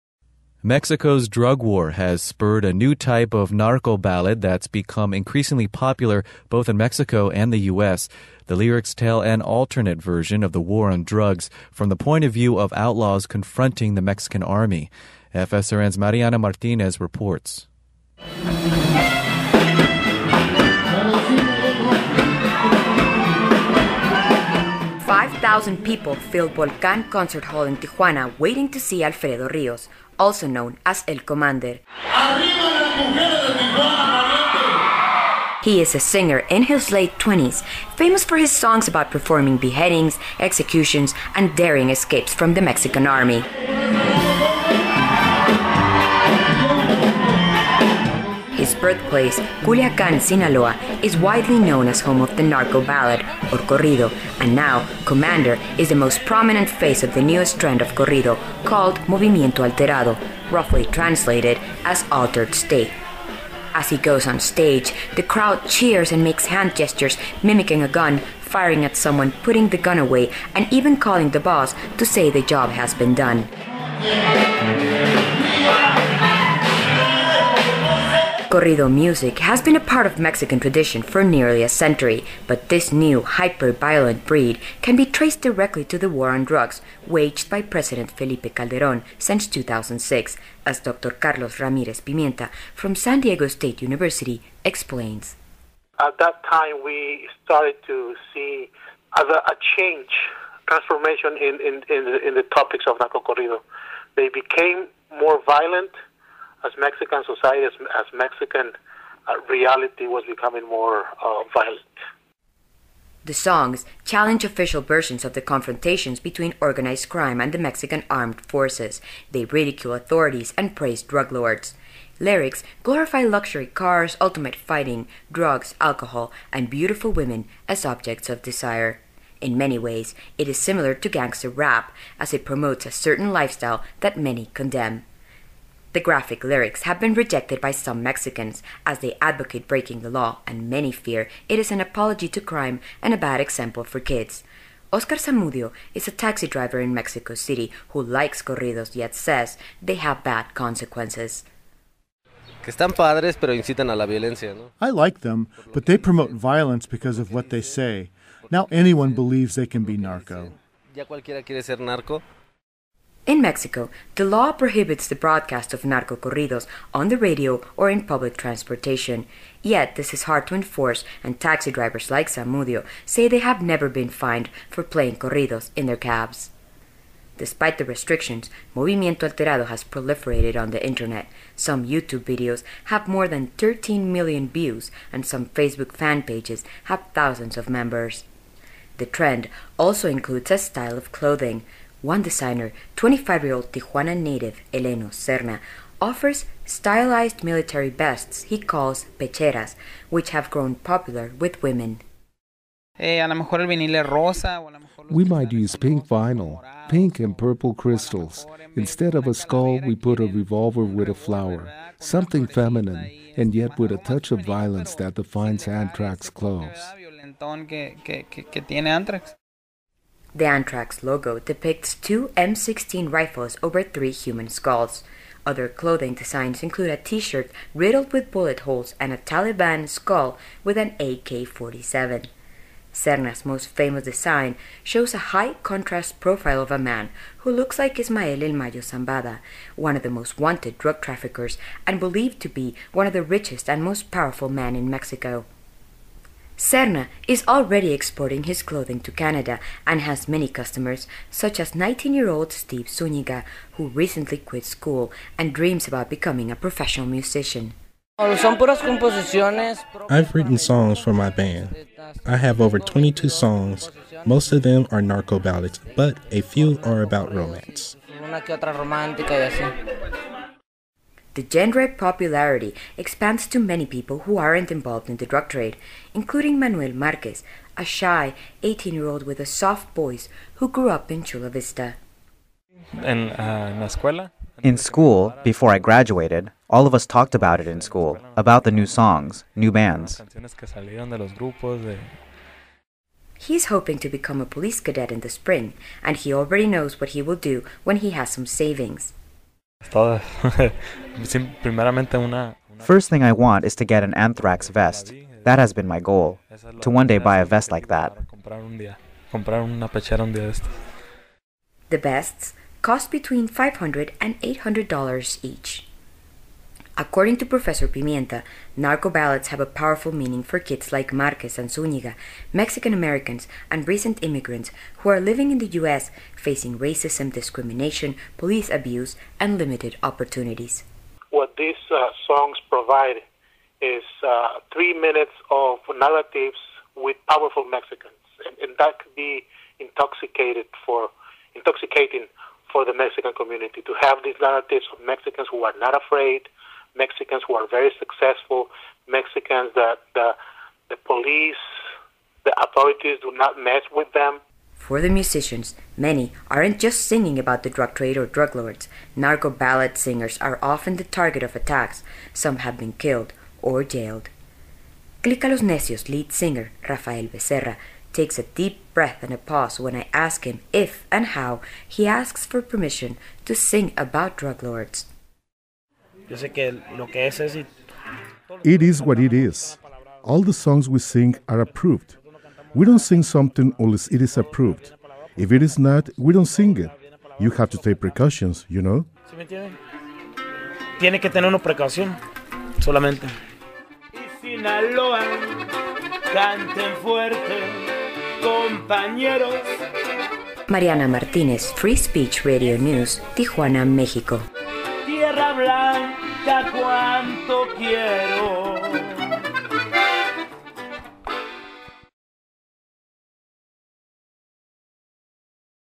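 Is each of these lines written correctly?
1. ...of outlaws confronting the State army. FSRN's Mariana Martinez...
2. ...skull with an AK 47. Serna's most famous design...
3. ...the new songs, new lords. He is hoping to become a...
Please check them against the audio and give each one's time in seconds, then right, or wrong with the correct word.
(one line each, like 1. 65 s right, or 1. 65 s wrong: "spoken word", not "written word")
1. 12 s wrong: "Mexican", not "State"
2. 229 s right
3. 288 s wrong: "bands", not "lords".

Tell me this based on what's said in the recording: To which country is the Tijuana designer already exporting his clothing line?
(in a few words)
Canada.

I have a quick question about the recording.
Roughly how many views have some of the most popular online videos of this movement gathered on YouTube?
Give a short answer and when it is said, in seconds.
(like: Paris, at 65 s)
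13 million, at 183 s.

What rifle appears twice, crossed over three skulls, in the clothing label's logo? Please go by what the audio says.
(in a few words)
M16.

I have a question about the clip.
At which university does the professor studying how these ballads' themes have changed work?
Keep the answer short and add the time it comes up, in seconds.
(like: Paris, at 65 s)
San Diego State University, at 92 s.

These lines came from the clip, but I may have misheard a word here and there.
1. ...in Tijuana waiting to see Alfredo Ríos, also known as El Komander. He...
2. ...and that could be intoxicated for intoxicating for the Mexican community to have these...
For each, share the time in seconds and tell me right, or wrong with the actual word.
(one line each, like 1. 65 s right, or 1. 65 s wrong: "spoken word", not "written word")
1. 27 s right
2. 338 s right.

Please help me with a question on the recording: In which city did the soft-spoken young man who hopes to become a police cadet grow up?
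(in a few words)
Chula Vista.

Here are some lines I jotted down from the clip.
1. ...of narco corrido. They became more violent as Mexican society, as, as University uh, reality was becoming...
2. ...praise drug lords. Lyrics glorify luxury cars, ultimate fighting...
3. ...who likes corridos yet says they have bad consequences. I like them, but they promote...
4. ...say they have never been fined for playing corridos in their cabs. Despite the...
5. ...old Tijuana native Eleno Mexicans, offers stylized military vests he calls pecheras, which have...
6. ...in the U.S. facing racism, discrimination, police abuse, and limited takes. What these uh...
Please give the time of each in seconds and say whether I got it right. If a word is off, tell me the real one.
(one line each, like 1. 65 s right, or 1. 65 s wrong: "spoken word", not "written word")
1. 102 s wrong: "Mexican", not "University"
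2. 120 s right
3. 147 s right
4. 173 s right
5. 193 s wrong: "Serna", not "Mexicans"
6. 325 s wrong: "opportunities", not "takes".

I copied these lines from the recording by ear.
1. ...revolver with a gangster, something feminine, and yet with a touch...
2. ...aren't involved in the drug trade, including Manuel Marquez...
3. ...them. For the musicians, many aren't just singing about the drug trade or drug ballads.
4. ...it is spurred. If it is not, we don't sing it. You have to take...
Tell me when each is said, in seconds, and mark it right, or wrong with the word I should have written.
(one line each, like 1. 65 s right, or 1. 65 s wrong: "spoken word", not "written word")
1. 210 s wrong: "flower", not "gangster"
2. 274 s right
3. 354 s wrong: "lords", not "ballads"
4. 384 s wrong: "approved", not "spurred".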